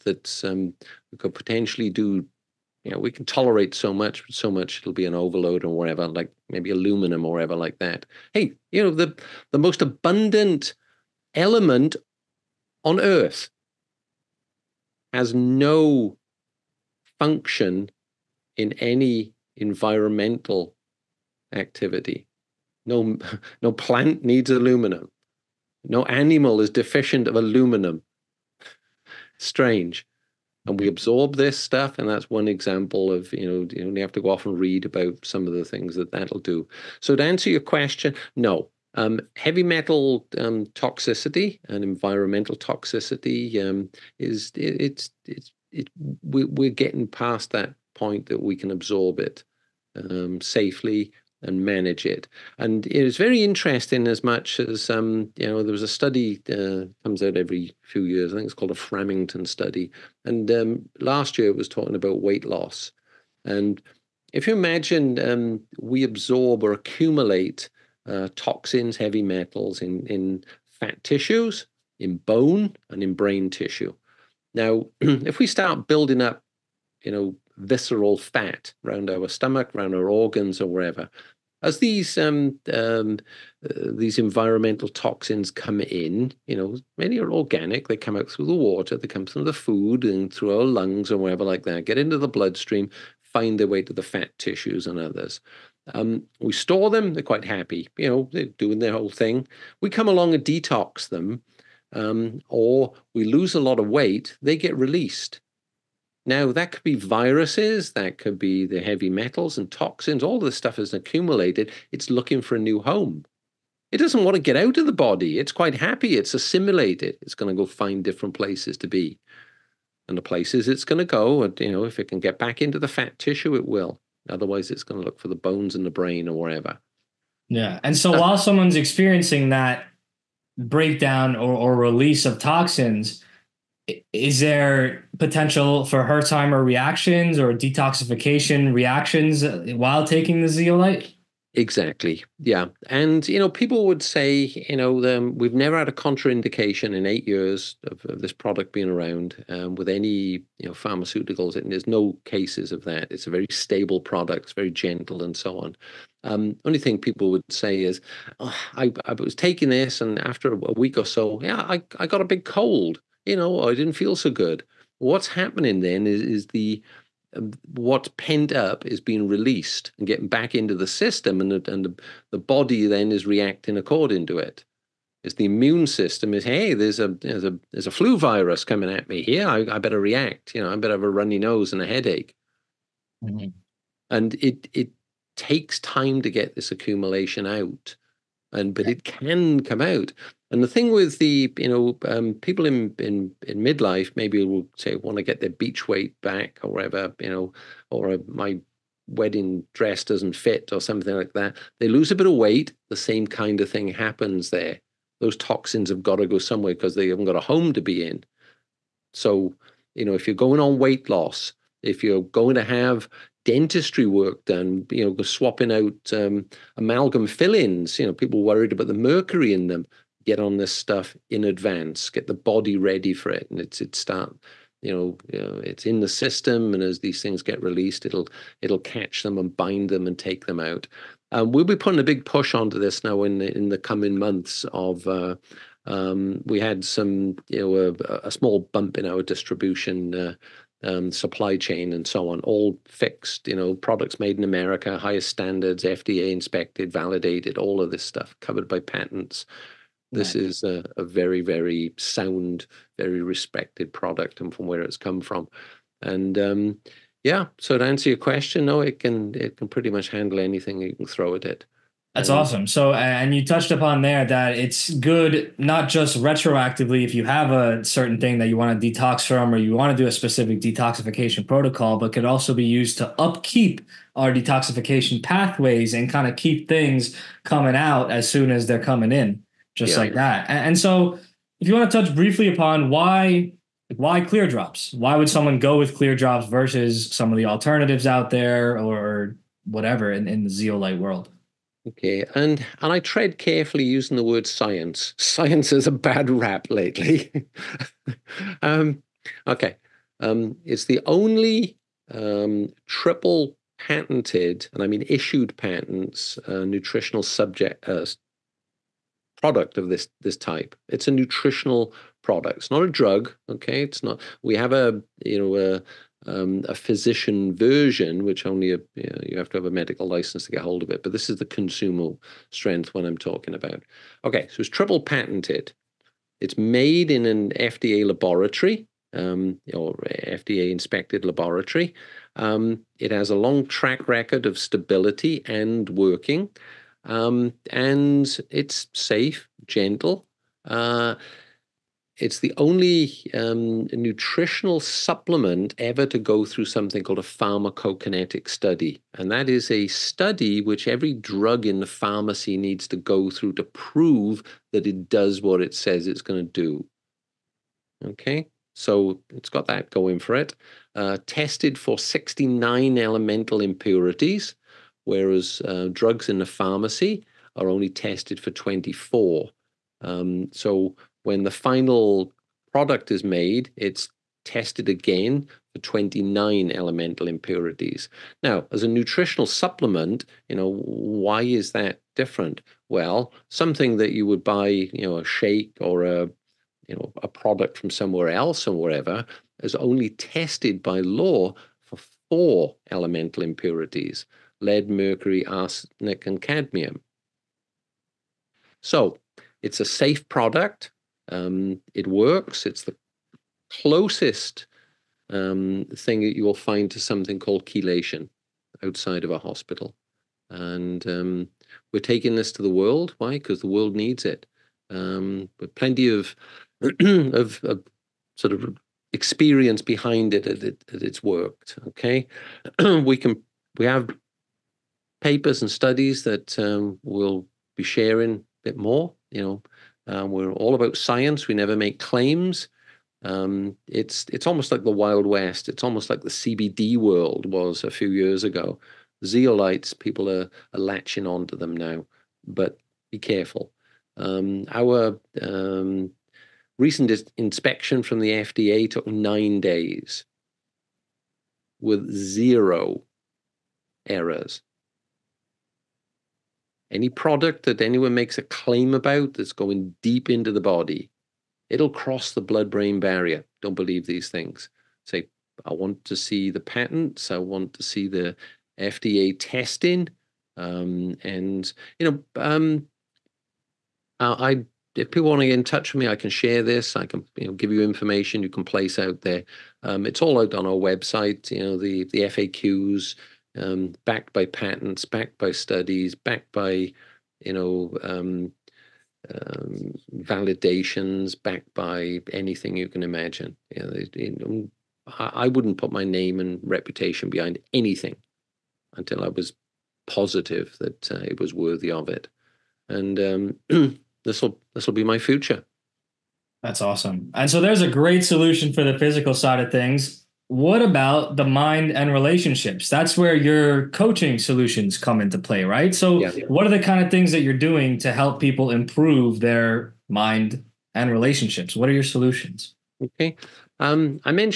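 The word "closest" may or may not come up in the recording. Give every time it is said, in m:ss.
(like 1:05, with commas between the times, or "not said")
6:43.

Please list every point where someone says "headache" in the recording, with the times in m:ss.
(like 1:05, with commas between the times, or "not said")
3:01.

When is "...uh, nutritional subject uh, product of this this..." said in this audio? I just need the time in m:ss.
5:06.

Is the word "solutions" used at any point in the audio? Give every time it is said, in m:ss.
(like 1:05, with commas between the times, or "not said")
8:28, 8:34, 8:42.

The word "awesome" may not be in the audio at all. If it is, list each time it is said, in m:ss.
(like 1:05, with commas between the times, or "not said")
4:22, 8:26.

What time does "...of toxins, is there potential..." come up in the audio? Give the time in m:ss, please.
2:12.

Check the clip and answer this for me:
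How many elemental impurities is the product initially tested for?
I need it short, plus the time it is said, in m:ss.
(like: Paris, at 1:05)
69, at 6:01.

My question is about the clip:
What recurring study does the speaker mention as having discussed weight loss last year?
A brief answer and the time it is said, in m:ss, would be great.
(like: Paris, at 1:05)
Framington study, at 0:58.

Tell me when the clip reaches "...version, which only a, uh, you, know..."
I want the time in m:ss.
5:17.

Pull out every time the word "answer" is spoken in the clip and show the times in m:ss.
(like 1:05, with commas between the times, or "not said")
0:37, 4:17.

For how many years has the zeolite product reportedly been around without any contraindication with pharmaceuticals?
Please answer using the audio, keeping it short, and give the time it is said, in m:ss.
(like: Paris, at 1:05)
8, at 2:27.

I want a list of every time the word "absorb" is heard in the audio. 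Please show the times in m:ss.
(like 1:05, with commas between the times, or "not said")
0:30, 0:48, 1:06.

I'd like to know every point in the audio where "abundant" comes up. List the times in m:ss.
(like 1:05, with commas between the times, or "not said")
0:09.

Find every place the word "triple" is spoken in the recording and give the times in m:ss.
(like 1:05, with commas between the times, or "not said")
5:02, 5:24.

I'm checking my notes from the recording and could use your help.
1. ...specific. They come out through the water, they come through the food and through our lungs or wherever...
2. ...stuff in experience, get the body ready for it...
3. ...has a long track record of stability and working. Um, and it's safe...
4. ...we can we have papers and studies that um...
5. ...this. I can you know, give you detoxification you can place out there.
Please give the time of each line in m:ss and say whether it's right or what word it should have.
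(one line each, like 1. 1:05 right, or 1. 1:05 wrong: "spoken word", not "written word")
1. 1:27 wrong: "organic", not "specific"
2. 3:40 wrong: "advance", not "experience"
3. 5:33 right
4. 7:02 right
5. 7:56 wrong: "information", not "detoxification".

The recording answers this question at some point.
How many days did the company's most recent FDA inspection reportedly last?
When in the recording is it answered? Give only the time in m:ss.
7:29.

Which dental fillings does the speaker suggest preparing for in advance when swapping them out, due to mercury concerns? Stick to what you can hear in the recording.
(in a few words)
amalgam fillings.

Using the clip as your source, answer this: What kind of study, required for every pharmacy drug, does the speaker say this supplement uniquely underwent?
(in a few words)
pharmacokinetic study.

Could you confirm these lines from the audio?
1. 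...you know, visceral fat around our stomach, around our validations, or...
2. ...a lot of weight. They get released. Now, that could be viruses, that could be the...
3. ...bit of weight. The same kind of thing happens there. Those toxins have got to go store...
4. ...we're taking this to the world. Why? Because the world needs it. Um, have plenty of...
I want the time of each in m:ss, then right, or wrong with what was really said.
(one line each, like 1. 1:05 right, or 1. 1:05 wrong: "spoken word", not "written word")
1. 1:17 wrong: "organs", not "validations"
2. 1:43 right
3. 3:22 wrong: "somewhere", not "store"
4. 6:51 right.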